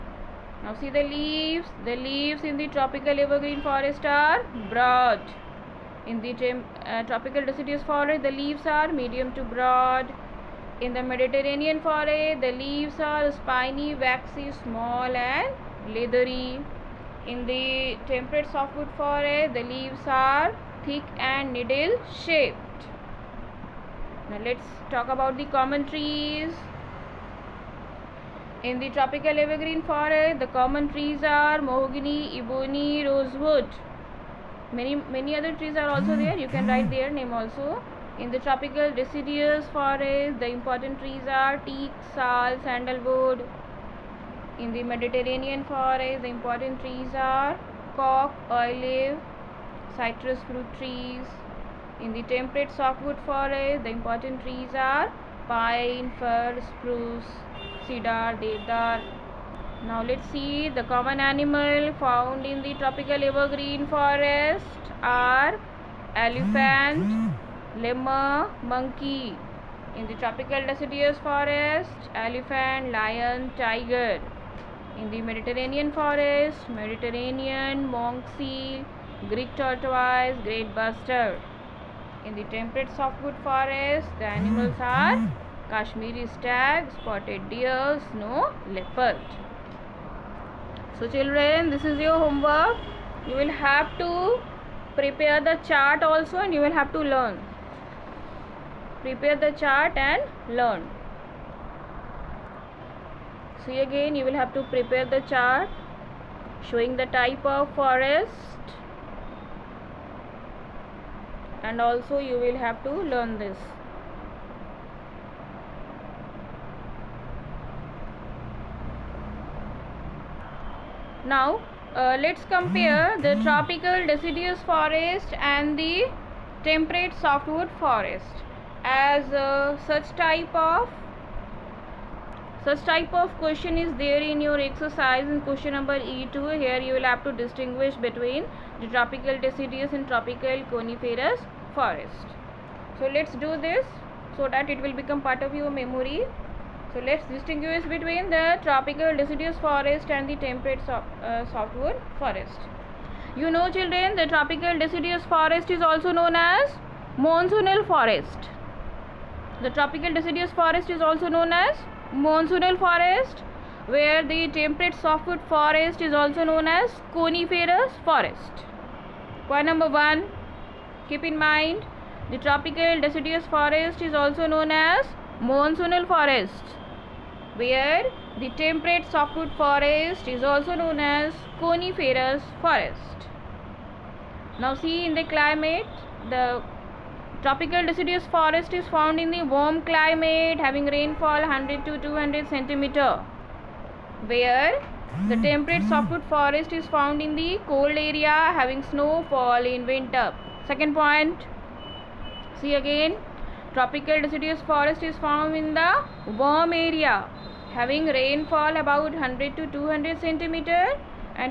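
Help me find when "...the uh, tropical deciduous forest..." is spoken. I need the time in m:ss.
0:06.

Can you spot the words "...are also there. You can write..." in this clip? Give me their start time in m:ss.
0:35.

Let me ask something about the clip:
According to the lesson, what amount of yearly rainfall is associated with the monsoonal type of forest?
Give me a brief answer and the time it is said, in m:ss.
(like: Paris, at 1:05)
100 to 200 centimeters, at 3:10.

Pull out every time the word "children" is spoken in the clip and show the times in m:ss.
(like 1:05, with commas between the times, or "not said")
1:31, 2:33.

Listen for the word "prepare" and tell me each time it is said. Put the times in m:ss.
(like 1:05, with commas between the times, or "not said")
1:34, 1:39, 1:44.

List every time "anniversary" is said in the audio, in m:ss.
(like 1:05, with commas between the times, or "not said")
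not said.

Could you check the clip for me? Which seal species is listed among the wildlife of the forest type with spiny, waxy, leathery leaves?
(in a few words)
Monk seal.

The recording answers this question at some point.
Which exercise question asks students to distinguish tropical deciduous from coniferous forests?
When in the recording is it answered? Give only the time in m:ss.
2:15.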